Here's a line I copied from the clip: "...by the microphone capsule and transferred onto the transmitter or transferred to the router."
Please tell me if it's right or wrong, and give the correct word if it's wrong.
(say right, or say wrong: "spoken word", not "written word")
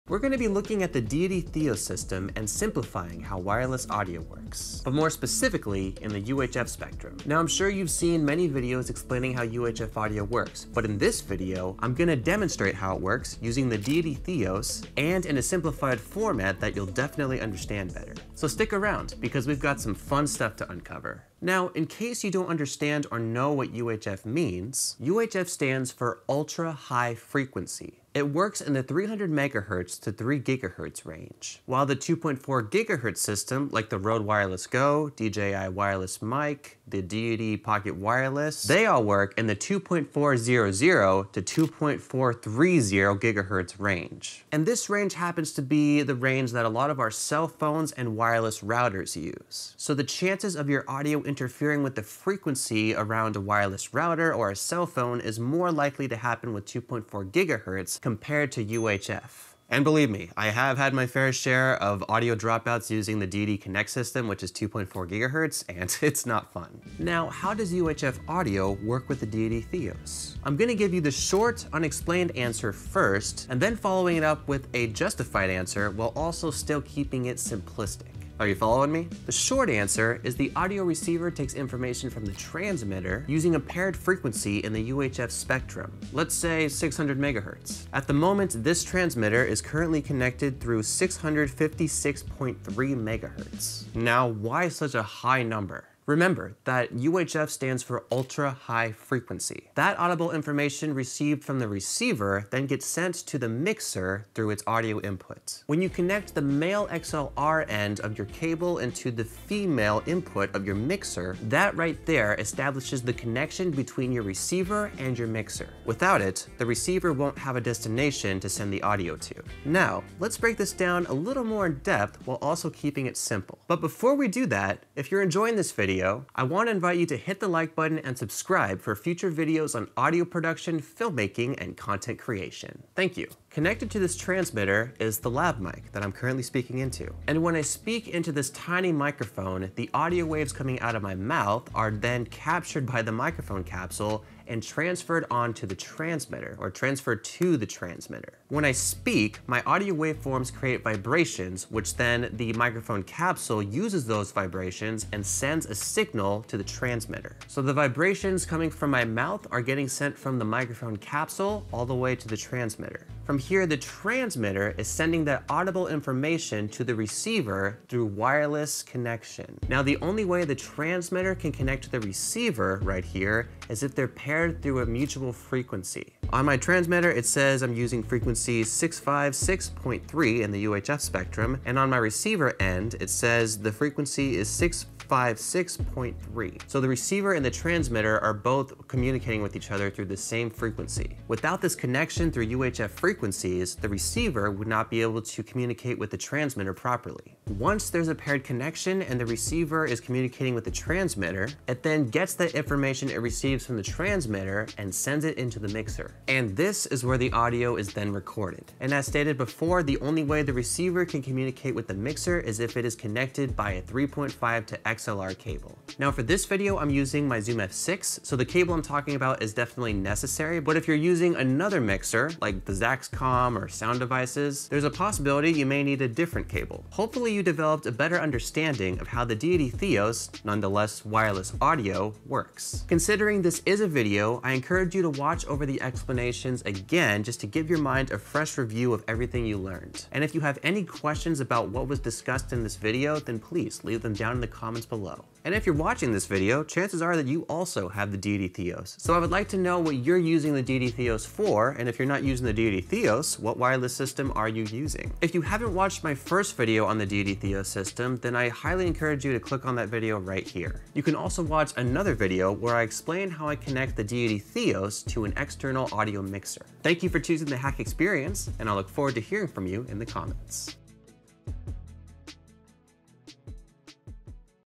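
wrong: "transmitter", not "router".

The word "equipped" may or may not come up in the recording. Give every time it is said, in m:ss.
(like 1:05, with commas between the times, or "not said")
not said.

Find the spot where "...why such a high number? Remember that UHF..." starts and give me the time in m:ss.
1:34.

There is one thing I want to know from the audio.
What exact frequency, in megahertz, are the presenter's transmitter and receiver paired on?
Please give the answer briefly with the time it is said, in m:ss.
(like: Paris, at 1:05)
656.3 MHz, at 1:30.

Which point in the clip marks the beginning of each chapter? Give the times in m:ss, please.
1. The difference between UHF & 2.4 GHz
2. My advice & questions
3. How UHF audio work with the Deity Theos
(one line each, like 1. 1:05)
1. 0:21
2. 3:46
3. 1:06.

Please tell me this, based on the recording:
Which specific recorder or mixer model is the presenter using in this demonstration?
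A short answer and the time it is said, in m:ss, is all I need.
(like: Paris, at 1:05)
Zoom F6, at 3:37.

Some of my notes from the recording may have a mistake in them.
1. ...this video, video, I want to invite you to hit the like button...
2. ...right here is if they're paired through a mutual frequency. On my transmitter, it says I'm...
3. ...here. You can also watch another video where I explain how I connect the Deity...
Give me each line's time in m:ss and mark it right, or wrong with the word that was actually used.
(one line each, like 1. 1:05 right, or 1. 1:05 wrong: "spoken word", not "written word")
1. 2:05 right
2. 2:52 right
3. 4:20 right.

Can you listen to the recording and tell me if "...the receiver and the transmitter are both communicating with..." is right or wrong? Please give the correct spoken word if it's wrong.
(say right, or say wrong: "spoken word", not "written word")
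right.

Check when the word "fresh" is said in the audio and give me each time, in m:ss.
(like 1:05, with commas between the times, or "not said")
3:58.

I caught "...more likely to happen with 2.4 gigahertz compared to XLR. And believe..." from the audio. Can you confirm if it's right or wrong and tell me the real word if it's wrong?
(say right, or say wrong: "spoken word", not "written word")
wrong: "UHF", not "XLR".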